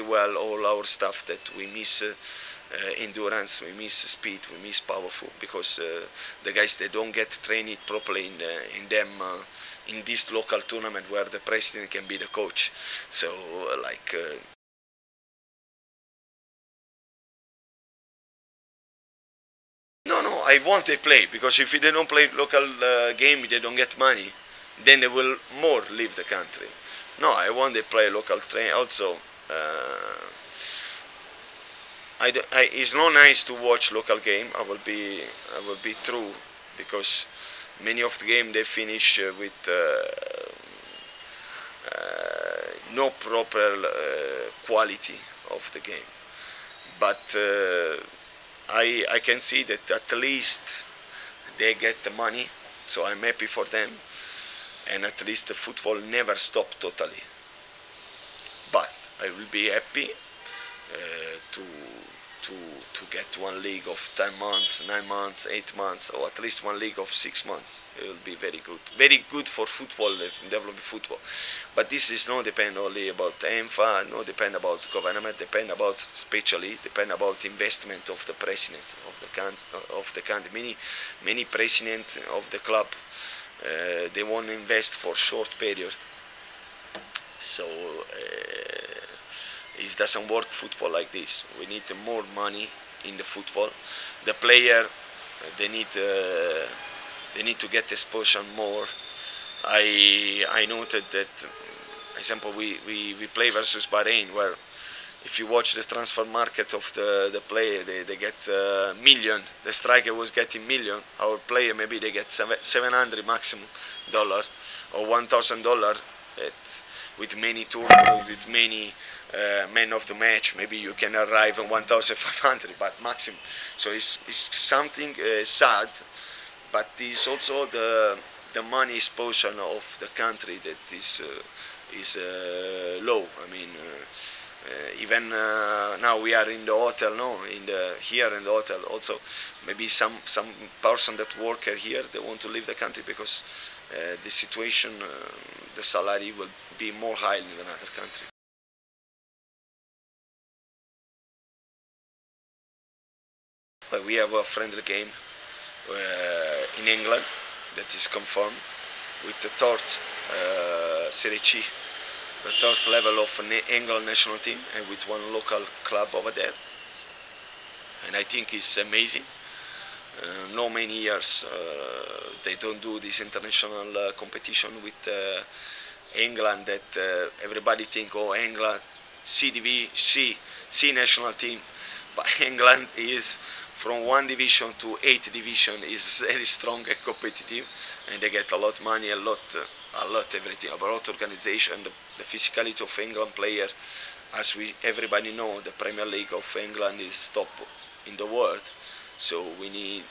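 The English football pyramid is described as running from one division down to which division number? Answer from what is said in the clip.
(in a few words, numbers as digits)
8.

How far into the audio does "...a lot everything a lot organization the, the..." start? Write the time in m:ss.
3:10.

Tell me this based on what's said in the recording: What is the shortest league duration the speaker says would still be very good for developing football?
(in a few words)
6 months.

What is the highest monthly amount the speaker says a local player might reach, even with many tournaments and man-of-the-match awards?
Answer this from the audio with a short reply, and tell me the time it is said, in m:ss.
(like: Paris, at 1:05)
1,500, at 2:01.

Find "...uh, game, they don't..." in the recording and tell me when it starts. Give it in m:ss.
0:22.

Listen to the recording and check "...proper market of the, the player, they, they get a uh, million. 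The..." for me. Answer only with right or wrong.
wrong.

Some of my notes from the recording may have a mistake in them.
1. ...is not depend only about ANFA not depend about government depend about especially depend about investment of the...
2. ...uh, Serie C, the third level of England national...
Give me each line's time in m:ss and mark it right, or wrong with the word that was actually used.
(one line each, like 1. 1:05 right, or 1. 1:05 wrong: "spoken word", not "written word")
1. 1:12 right
2. 2:39 right.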